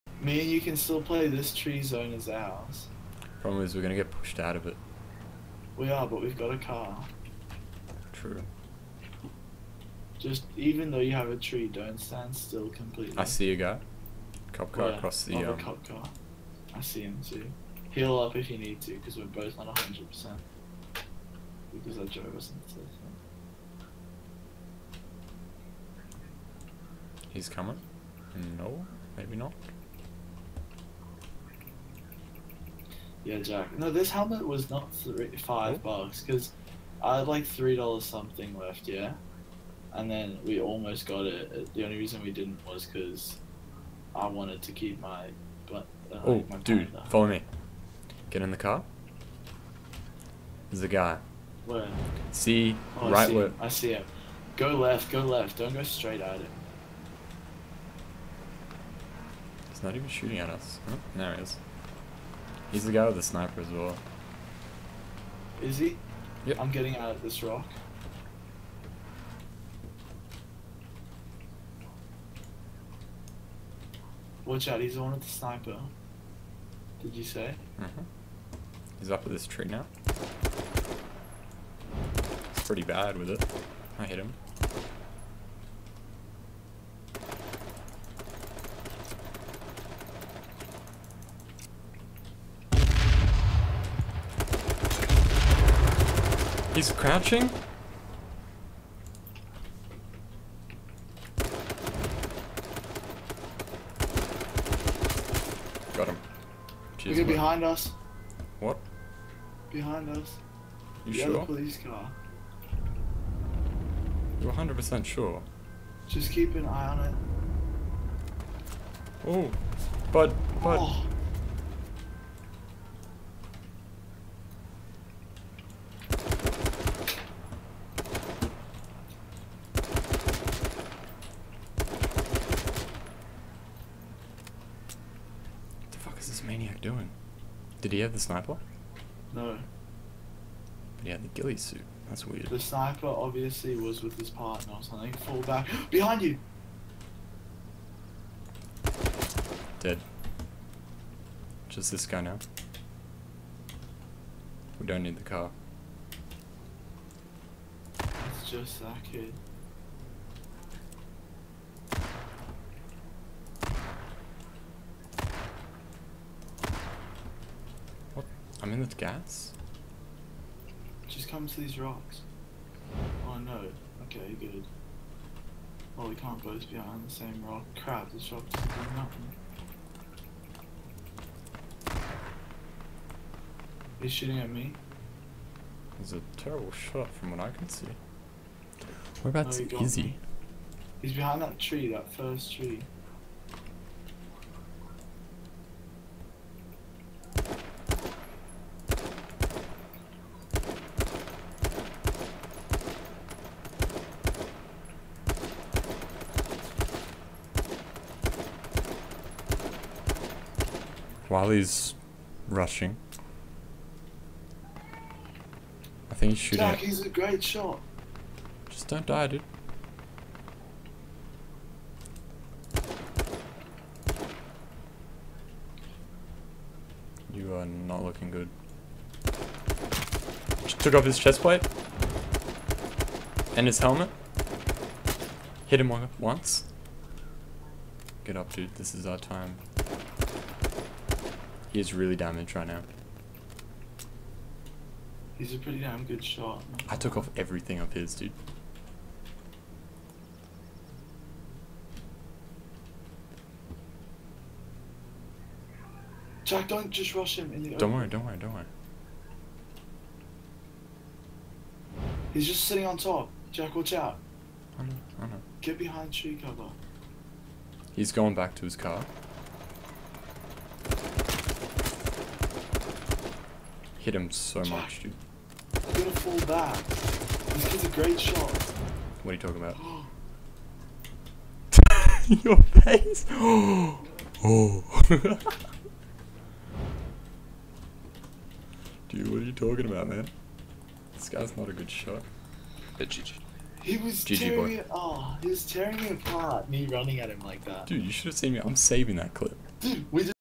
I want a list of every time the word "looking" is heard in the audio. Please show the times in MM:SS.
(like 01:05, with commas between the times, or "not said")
03:48.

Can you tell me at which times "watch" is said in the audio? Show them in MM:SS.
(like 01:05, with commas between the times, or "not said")
01:14, 04:23.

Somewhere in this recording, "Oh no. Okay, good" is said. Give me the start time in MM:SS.
02:53.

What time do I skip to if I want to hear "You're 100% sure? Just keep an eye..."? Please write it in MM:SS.
01:54.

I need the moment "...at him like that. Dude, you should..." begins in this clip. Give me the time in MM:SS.
04:57.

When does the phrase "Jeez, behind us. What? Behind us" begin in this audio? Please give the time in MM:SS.
01:46.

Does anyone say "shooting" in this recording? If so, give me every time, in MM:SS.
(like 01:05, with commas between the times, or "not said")
01:00, 03:04, 03:36.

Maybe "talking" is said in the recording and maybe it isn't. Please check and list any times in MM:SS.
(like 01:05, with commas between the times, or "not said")
04:39, 04:49.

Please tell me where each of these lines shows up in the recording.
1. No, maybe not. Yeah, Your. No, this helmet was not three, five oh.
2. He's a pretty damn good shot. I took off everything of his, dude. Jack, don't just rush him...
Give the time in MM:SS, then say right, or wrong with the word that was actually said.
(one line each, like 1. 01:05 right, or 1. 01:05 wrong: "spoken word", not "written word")
1. 00:28 wrong: "Jack", not "Your"
2. 04:05 right.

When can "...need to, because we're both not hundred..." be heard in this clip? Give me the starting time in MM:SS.
00:18.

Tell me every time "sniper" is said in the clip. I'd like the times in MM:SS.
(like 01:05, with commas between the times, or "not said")
01:03, 01:15, 02:18, 02:22.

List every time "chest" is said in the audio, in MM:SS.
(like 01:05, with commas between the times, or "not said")
03:51.